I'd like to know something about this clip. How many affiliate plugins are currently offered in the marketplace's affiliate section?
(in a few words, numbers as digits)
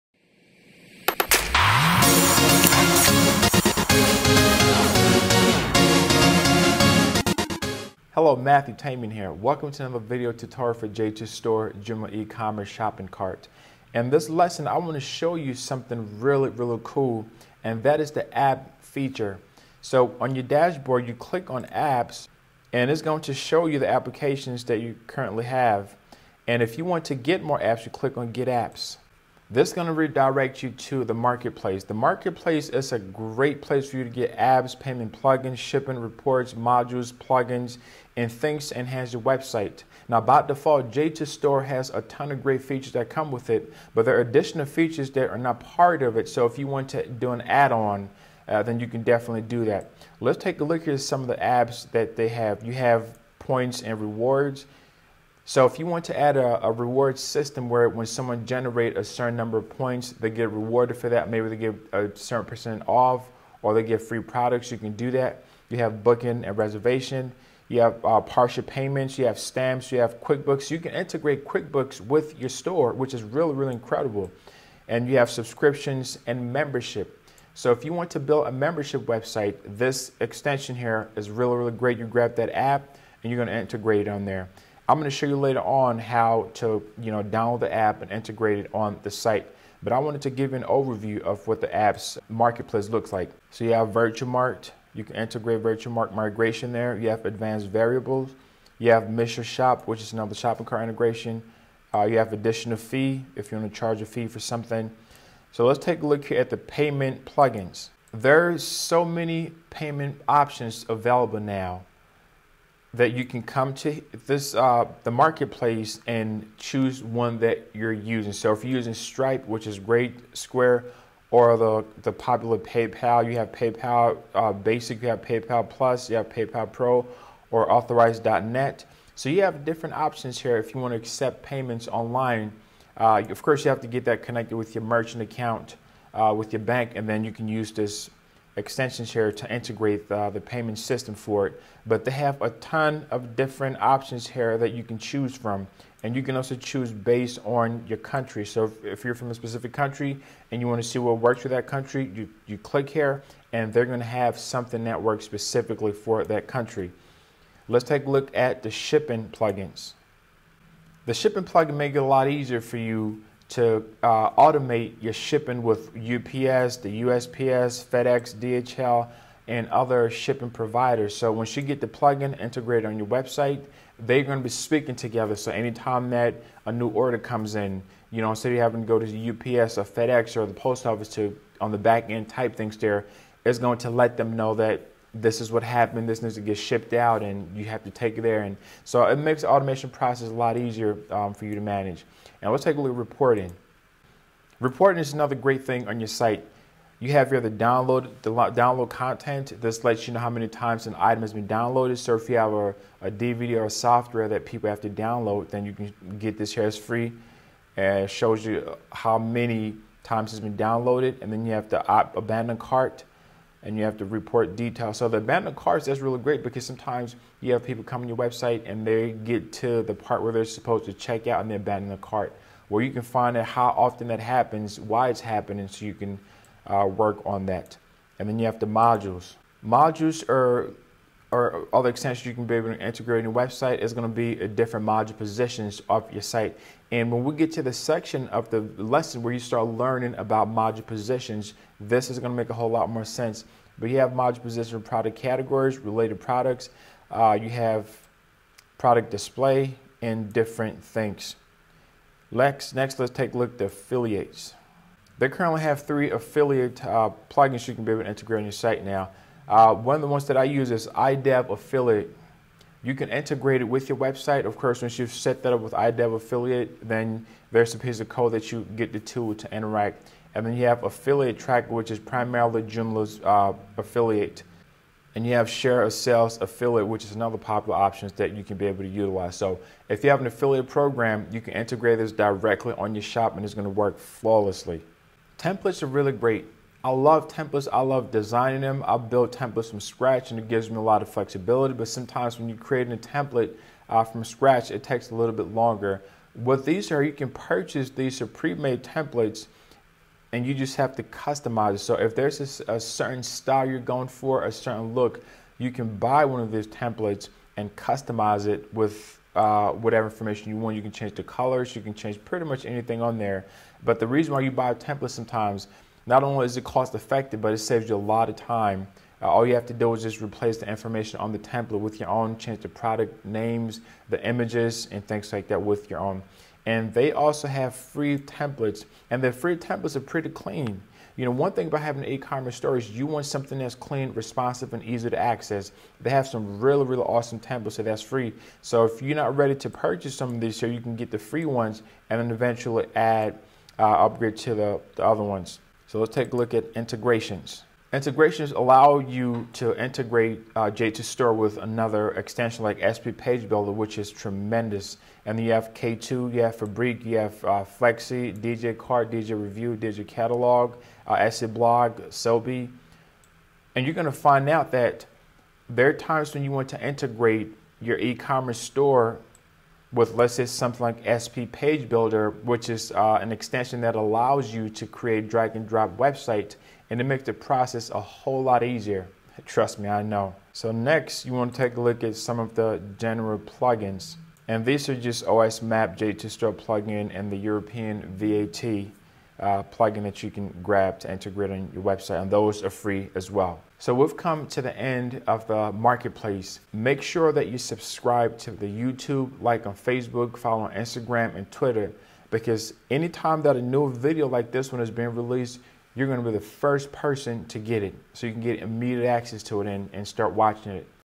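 3.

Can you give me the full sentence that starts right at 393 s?
So we've come to the end of the marketplace.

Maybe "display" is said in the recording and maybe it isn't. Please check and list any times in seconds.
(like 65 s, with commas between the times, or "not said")
249 s.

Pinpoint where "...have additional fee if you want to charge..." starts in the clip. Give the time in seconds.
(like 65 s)
102 s.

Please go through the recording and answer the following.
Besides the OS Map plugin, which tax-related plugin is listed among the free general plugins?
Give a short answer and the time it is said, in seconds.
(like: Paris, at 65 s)
European VAT, at 387 s.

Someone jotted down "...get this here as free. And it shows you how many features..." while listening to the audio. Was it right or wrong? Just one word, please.
wrong.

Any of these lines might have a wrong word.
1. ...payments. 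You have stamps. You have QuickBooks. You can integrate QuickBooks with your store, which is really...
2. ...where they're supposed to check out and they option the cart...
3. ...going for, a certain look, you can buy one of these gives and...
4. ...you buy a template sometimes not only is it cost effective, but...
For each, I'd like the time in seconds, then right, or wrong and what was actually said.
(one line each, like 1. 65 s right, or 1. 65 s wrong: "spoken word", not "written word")
1. 68 s right
2. 220 s wrong: "abandon", not "option"
3. 303 s wrong: "templates", not "gives"
4. 314 s right.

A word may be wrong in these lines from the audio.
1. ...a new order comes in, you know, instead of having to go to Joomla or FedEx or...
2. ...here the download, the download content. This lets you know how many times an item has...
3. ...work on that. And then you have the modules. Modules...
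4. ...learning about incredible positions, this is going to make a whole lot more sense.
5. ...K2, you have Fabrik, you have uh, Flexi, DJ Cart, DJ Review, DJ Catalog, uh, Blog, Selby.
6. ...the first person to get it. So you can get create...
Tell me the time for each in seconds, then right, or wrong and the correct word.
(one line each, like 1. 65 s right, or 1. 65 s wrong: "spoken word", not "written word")
1. 176 s wrong: "UPS", not "Joomla"
2. 197 s right
3. 226 s right
4. 239 s wrong: "module", not "incredible"
5. 355 s right
6. 406 s wrong: "immediate", not "create".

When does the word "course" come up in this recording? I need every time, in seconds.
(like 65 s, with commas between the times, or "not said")
133 s, 264 s.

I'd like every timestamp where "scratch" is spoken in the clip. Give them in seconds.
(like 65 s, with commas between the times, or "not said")
289 s, 294 s.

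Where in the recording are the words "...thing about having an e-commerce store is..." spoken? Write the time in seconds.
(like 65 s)
331 s.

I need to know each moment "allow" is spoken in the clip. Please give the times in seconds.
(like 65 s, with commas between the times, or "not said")
348 s, 373 s.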